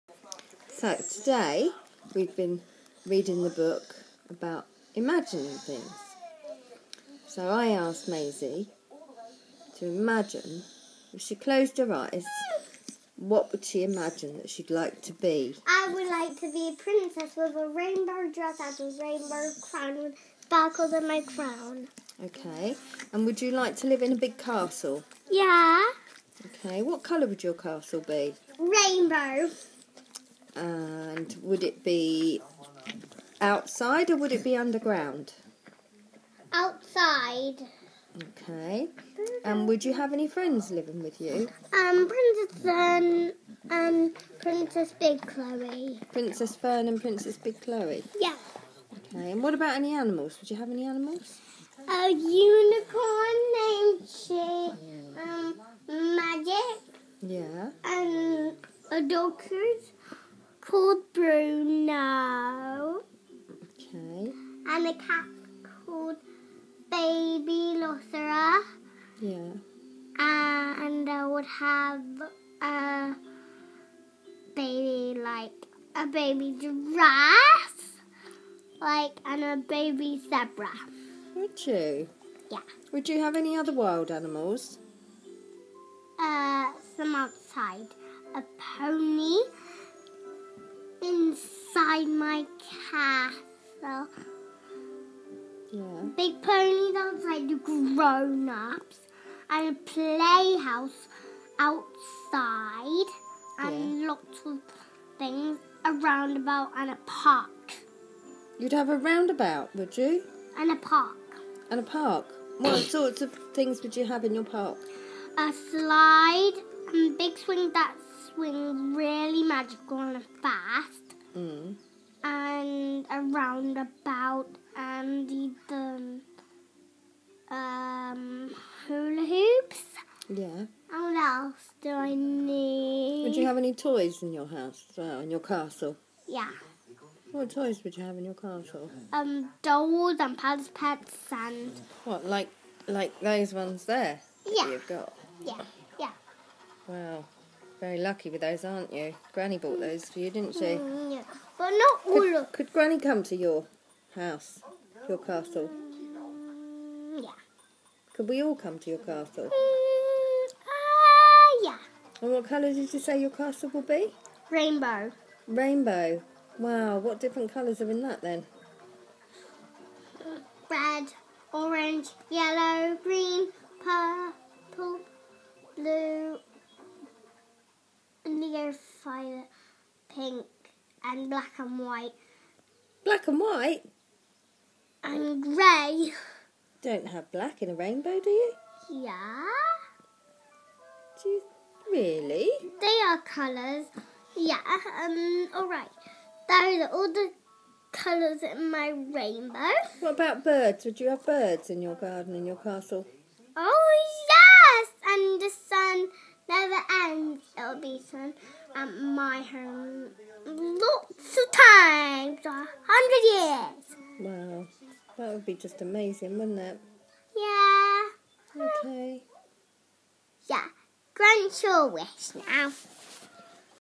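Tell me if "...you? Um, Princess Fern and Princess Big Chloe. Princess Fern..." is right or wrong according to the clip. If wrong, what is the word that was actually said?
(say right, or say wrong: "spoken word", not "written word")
right.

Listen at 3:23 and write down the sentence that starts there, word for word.
Oh yes, and the sun never ends.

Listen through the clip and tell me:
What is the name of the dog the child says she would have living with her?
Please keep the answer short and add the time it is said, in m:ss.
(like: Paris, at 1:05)
Bruno, at 1:01.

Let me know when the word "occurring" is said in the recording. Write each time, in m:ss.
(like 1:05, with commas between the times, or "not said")
not said.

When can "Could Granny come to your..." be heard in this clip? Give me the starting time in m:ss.
2:32.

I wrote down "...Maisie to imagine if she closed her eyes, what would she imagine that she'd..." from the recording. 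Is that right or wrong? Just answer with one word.
right.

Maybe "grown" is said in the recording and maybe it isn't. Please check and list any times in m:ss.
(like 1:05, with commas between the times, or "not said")
1:37.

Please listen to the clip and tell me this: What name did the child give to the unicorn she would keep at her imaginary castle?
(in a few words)
Magic.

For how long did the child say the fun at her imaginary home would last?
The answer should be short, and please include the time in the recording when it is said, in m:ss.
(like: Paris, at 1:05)
100 years, at 3:32.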